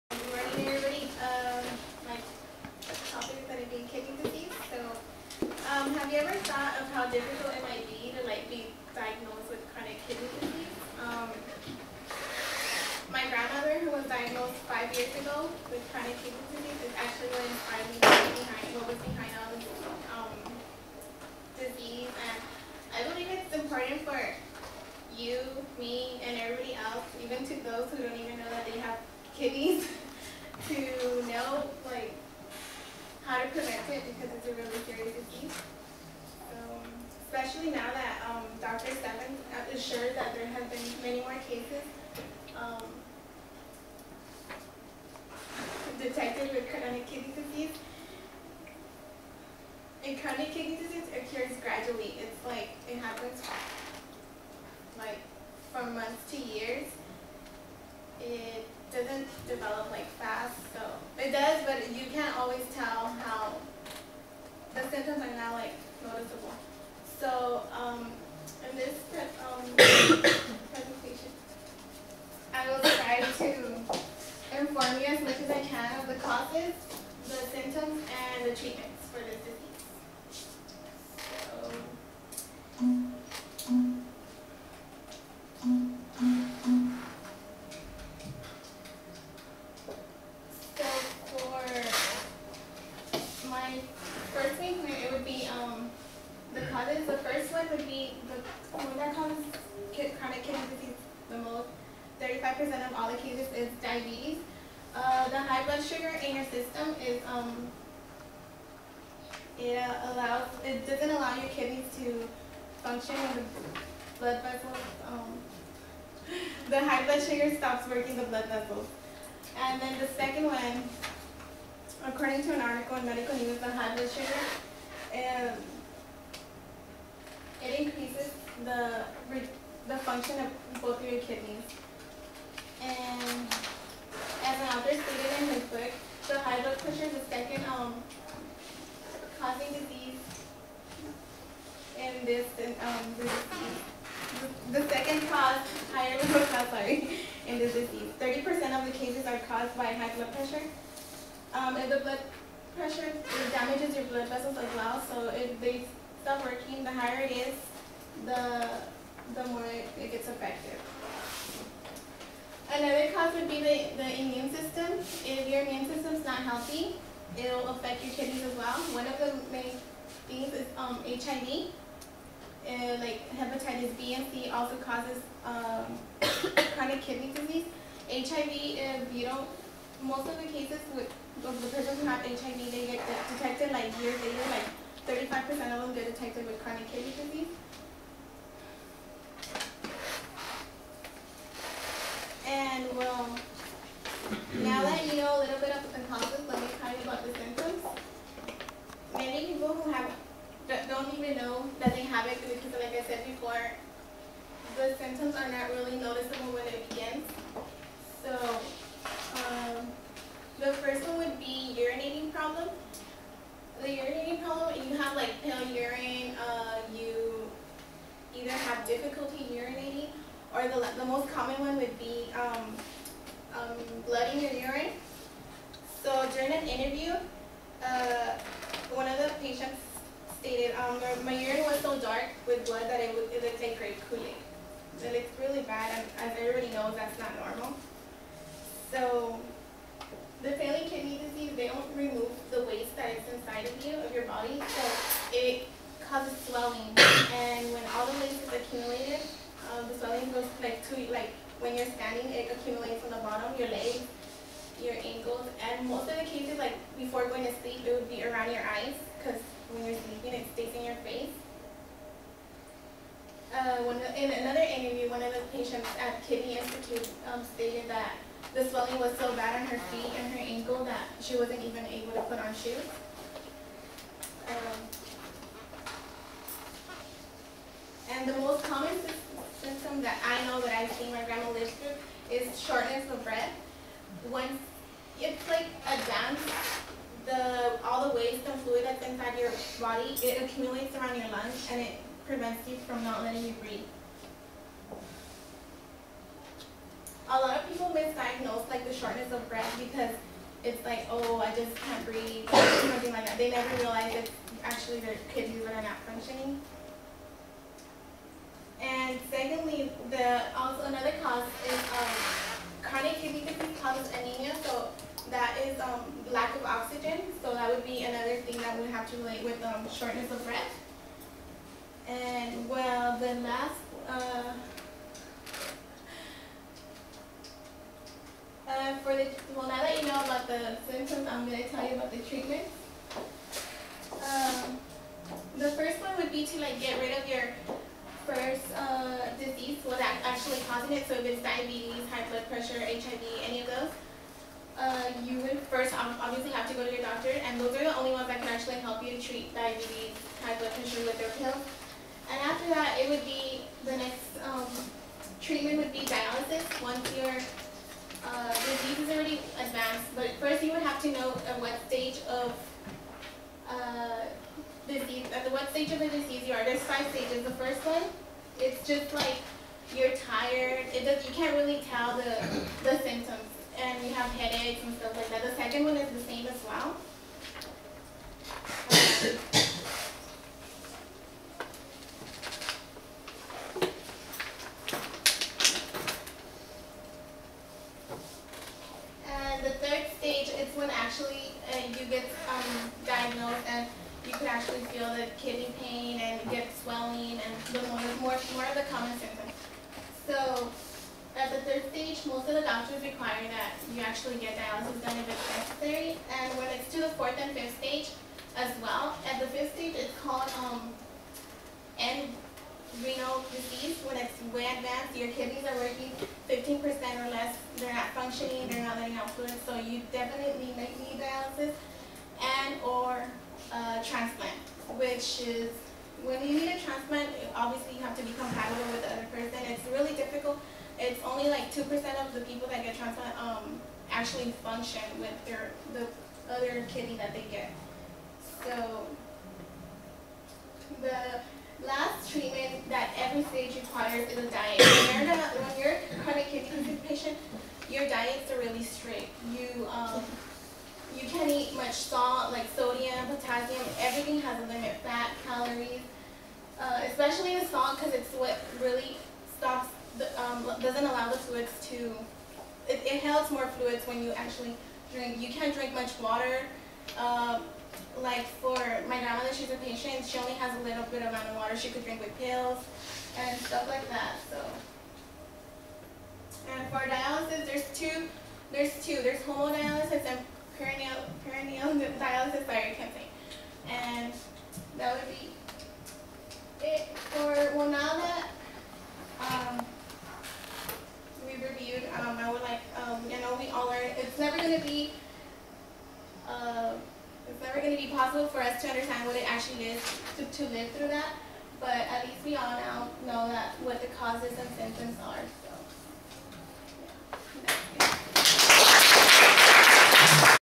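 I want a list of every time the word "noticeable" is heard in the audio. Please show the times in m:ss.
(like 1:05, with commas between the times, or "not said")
1:06, 3:25.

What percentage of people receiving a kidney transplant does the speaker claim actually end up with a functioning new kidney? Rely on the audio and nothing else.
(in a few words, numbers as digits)
2%.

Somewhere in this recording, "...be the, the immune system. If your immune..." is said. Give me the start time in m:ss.
2:43.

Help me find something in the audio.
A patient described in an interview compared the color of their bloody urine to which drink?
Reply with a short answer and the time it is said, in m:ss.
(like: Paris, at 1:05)
grape Kool-Aid, at 3:53.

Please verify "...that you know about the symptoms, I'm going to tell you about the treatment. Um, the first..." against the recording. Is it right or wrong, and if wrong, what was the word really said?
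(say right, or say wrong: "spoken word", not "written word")
right.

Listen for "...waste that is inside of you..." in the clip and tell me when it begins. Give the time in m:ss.
4:02.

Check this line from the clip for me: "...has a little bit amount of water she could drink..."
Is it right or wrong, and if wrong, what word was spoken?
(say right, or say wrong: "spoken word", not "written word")
right.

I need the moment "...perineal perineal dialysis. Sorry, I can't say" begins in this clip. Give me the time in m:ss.
8:00.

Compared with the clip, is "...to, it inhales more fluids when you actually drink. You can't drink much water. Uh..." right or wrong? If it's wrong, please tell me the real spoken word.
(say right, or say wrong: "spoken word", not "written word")
right.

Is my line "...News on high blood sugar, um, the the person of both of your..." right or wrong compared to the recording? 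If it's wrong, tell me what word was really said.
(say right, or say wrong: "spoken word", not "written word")
wrong: "function", not "person".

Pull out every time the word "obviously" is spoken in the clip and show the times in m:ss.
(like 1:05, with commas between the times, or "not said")
5:45, 7:07.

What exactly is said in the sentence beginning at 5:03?
They never realize it's actually their kidneys that are not functioning.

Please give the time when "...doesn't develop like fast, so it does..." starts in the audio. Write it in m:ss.
0:58.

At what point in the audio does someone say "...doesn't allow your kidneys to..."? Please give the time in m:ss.
1:50.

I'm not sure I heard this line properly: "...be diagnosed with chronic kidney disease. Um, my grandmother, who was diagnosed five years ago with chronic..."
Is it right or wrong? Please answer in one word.
right.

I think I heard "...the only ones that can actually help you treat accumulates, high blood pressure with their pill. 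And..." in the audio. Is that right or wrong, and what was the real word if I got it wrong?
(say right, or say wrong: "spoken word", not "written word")
wrong: "diabetes", not "accumulates".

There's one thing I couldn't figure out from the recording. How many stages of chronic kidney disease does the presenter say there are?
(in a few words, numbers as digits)
5.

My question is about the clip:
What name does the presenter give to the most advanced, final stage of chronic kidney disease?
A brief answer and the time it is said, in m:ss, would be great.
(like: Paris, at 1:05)
end renal disease, at 6:51.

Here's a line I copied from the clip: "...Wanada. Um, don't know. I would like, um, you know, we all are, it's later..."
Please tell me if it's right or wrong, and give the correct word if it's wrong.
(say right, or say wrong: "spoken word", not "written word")
wrong: "never", not "later".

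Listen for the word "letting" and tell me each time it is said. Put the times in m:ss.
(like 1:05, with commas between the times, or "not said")
4:53, 6:58.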